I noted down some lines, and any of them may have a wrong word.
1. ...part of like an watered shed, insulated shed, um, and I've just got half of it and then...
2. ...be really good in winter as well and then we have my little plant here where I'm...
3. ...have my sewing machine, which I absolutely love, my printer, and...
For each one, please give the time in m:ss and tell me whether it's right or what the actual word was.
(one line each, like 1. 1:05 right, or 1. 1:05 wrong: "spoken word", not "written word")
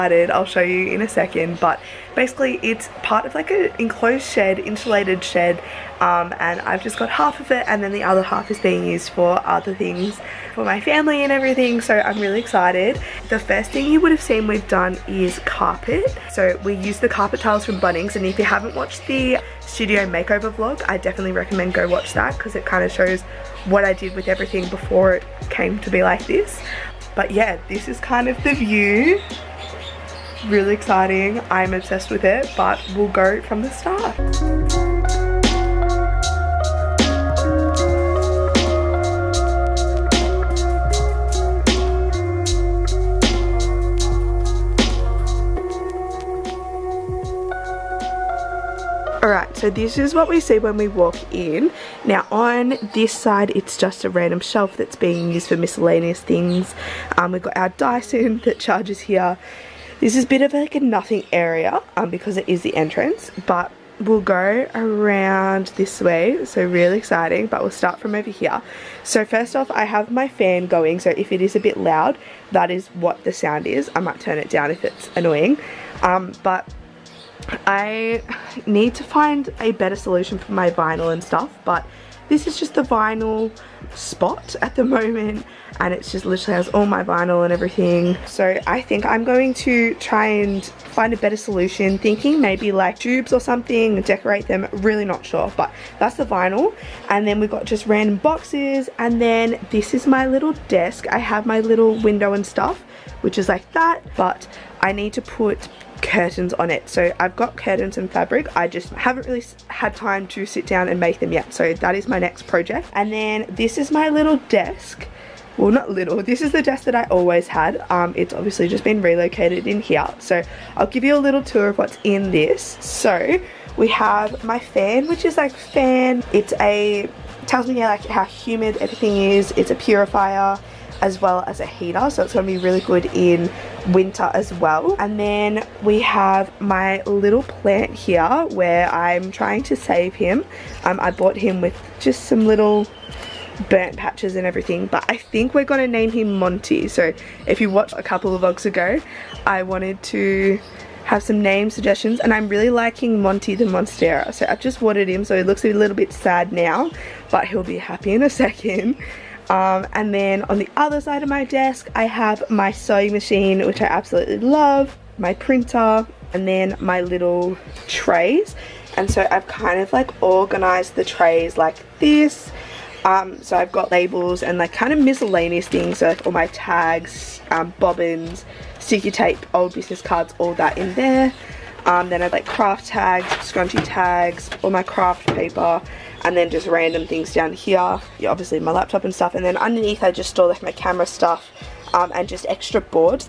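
1. 0:03 wrong: "enclosed", not "watered"
2. 2:12 right
3. 2:42 right.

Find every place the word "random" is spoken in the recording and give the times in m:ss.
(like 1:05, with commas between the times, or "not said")
0:54, 1:37, 3:06.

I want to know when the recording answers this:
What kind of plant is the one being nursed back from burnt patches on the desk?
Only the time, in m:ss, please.
2:33.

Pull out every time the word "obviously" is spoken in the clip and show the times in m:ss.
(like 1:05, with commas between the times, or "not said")
1:58, 3:08.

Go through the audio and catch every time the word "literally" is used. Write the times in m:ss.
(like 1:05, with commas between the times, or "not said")
1:26.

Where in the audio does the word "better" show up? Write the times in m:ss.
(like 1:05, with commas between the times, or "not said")
1:19, 1:31.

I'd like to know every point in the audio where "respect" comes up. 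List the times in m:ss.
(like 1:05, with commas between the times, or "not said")
not said.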